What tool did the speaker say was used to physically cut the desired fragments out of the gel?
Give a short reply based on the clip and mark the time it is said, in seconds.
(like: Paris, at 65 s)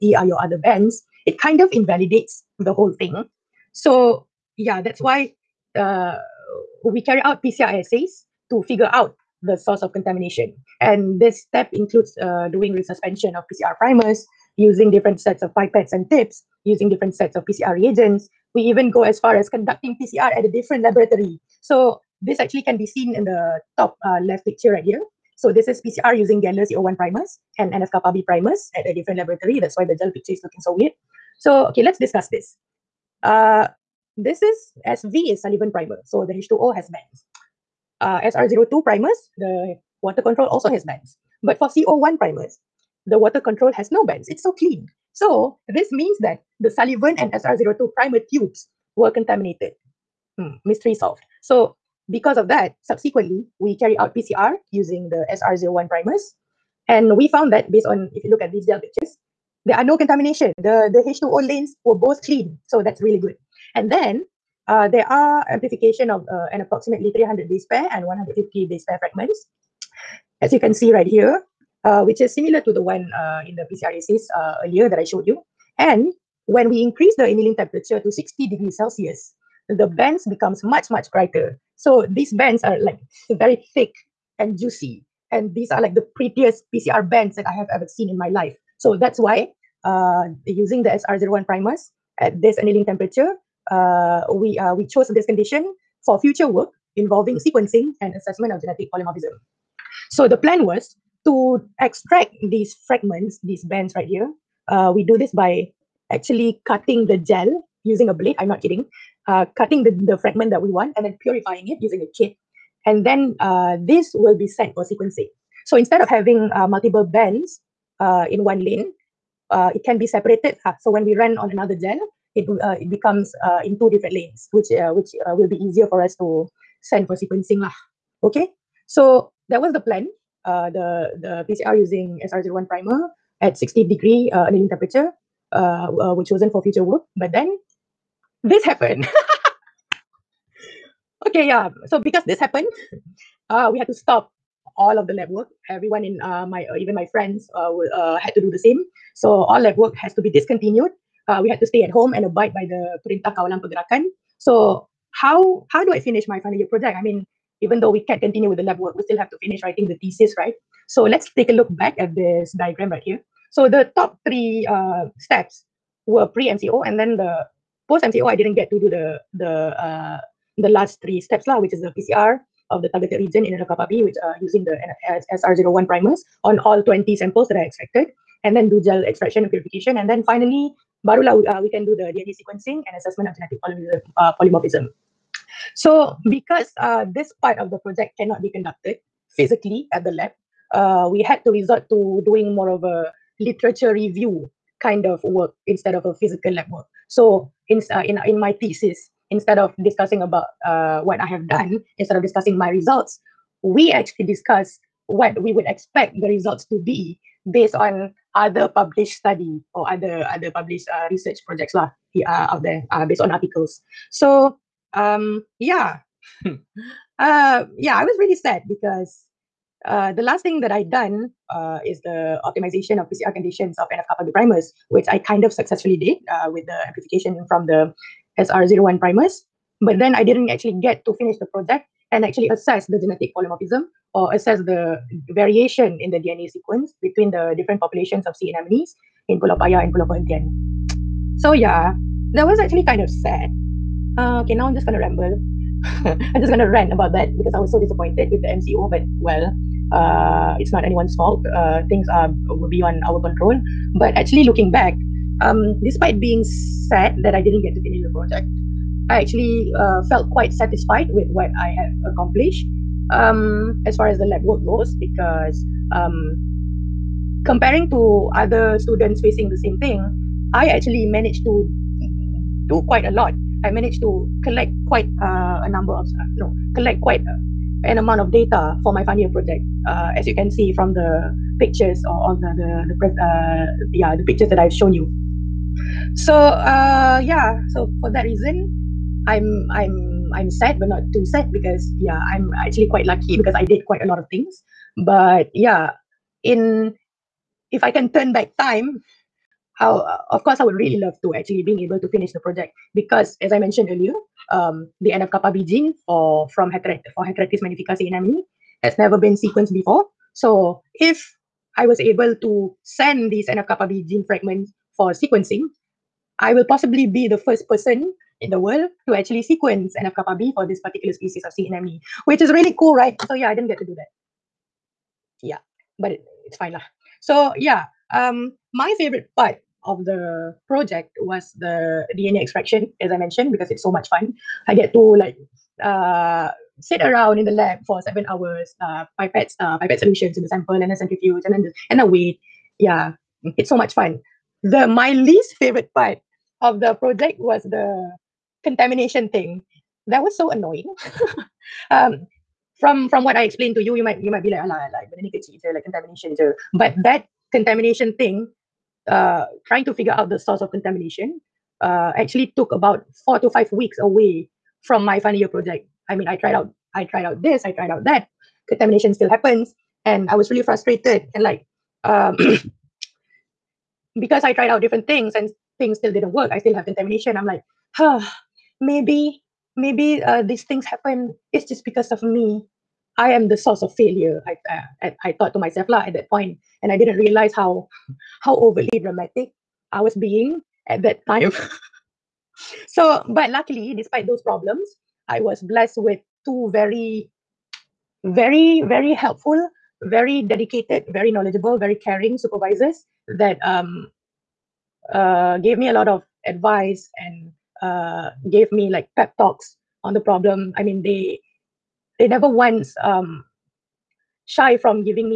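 A blade, at 108 s.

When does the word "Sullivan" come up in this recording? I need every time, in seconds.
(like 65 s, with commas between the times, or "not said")
35 s, 46 s.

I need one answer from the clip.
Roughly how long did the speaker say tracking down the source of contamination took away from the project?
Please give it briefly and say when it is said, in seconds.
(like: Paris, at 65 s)
4 to 5 weeks, at 363 s.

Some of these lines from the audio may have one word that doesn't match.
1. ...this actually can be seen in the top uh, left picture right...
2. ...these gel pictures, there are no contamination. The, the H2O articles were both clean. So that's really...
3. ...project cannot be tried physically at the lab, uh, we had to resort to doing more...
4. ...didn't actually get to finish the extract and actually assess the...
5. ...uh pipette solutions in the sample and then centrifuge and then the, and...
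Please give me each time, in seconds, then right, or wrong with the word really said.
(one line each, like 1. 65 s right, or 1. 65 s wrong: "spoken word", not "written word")
1. 22 s right
2. 58 s wrong: "lanes", not "articles"
3. 187 s wrong: "conducted", not "tried"
4. 230 s wrong: "project", not "extract"
5. 339 s right.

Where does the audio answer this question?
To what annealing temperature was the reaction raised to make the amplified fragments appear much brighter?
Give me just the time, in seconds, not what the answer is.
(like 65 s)
78 s.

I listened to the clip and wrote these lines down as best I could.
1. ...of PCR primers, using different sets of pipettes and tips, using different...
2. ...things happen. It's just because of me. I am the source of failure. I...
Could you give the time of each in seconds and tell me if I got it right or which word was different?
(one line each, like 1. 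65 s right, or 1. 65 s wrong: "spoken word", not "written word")
1. 13 s right
2. 380 s right.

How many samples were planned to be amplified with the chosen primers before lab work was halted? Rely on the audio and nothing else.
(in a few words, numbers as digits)
20.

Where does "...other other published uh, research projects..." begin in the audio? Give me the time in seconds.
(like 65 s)
209 s.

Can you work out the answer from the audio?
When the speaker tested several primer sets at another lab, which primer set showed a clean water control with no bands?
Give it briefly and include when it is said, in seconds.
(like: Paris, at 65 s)
CO1, at 41 s.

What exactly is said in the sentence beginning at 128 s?
Okay, so that was the plan.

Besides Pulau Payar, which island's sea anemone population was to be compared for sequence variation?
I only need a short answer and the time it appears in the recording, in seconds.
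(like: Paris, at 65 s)
Pulau Perhentian, at 239 s.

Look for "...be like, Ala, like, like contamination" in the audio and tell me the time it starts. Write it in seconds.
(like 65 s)
354 s.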